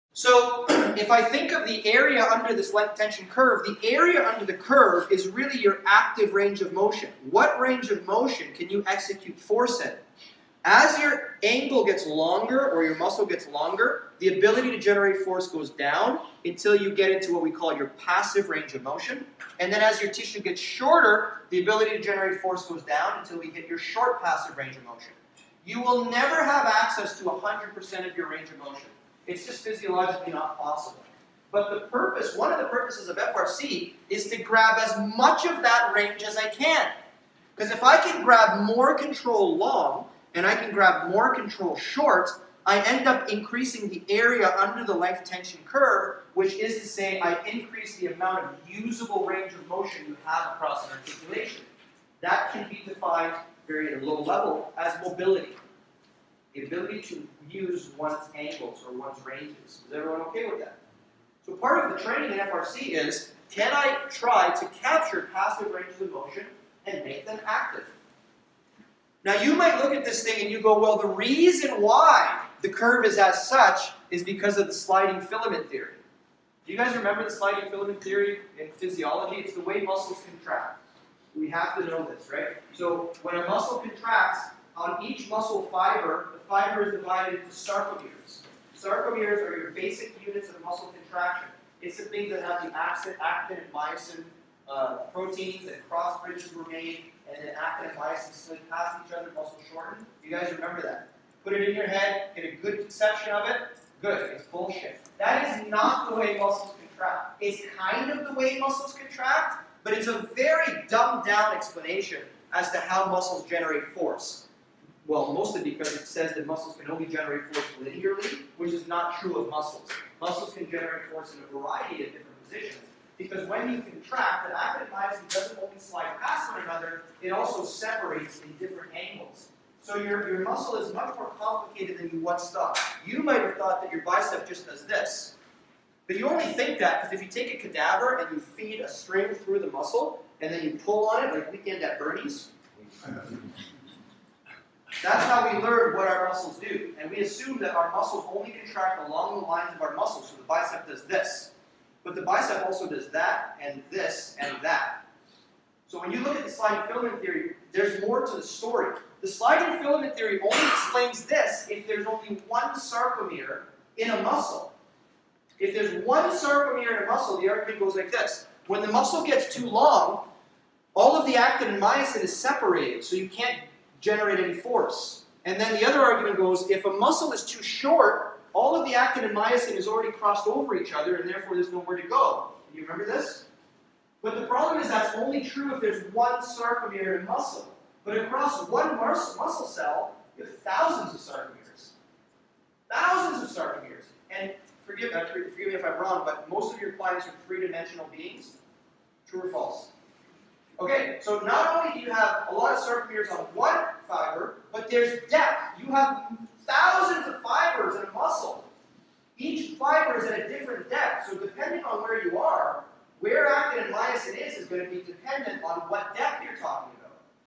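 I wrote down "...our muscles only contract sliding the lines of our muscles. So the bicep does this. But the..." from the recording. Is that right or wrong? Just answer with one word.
wrong.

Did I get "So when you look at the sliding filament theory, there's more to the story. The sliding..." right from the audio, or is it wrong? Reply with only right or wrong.
right.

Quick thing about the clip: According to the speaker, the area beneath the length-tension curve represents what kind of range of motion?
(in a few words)
Active range of motion.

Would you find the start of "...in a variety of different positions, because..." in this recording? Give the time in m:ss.
2:01.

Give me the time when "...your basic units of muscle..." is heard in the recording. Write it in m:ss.
1:29.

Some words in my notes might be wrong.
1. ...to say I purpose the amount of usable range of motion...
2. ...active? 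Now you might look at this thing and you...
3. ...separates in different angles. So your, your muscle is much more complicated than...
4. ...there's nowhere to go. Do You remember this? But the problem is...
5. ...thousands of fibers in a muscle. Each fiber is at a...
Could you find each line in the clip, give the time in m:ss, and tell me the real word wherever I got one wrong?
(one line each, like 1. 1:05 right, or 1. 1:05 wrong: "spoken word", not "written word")
1. 0:46 wrong: "increase", not "purpose"
2. 1:07 right
3. 2:07 right
4. 3:01 right
5. 3:26 right.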